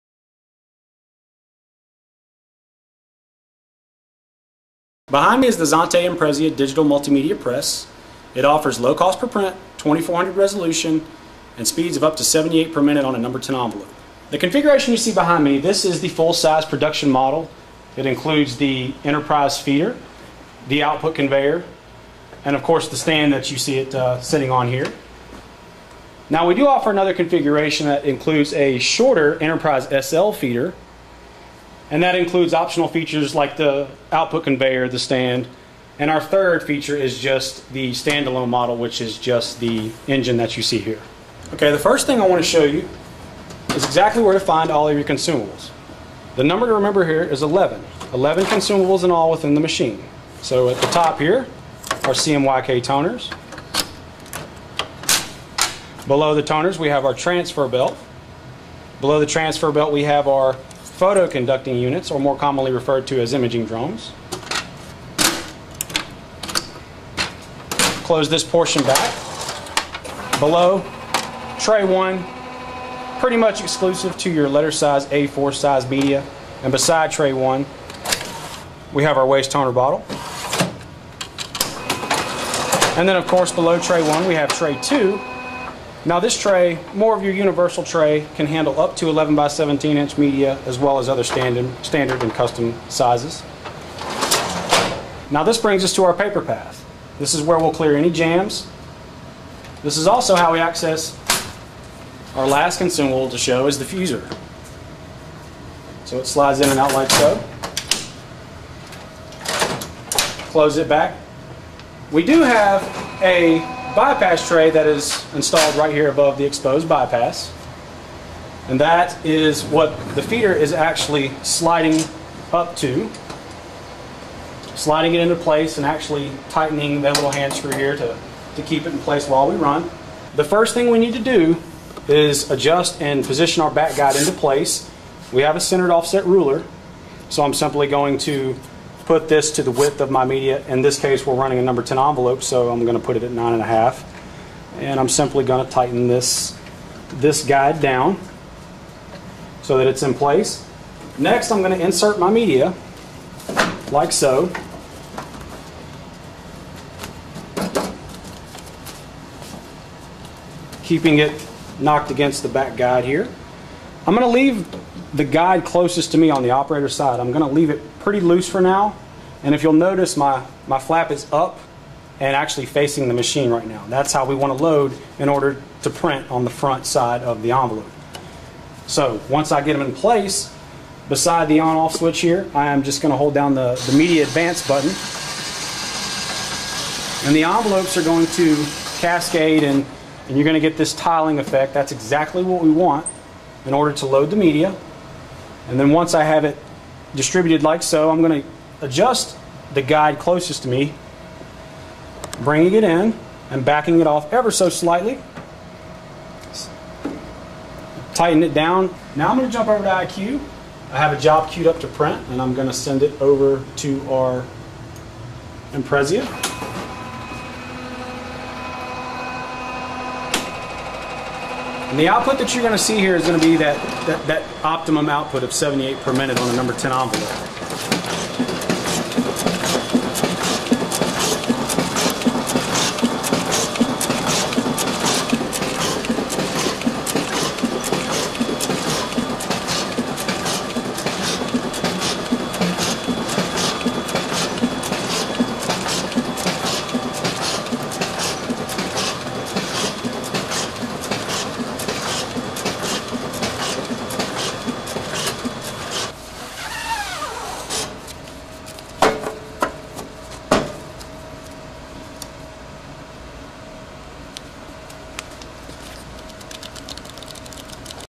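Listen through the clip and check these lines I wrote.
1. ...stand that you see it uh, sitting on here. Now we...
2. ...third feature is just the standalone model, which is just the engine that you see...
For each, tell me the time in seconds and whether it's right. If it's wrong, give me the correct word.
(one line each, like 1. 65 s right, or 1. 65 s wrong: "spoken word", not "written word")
1. 22 s right
2. 36 s right.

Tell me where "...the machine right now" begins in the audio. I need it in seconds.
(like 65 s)
173 s.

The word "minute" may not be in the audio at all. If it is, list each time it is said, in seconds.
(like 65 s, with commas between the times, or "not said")
12 s, 226 s.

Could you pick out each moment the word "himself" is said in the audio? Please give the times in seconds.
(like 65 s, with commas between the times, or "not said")
not said.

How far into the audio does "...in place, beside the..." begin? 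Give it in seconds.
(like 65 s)
179 s.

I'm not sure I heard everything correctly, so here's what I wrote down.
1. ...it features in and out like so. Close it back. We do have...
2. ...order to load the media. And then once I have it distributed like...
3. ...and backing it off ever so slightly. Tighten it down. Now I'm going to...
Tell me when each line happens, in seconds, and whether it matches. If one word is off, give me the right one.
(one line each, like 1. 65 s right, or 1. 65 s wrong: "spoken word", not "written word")
1. 106 s wrong: "slides", not "features"
2. 193 s right
3. 203 s right.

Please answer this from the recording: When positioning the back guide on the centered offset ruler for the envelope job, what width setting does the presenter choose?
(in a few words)
9.5.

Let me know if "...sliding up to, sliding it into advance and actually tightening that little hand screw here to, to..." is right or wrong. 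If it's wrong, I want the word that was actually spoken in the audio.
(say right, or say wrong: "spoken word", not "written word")
wrong: "place", not "advance".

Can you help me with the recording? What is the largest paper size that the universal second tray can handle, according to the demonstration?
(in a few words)
11 by 17 inch.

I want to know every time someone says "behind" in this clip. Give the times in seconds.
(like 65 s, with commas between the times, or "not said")
5 s, 15 s.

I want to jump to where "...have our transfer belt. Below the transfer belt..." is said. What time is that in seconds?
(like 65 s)
56 s.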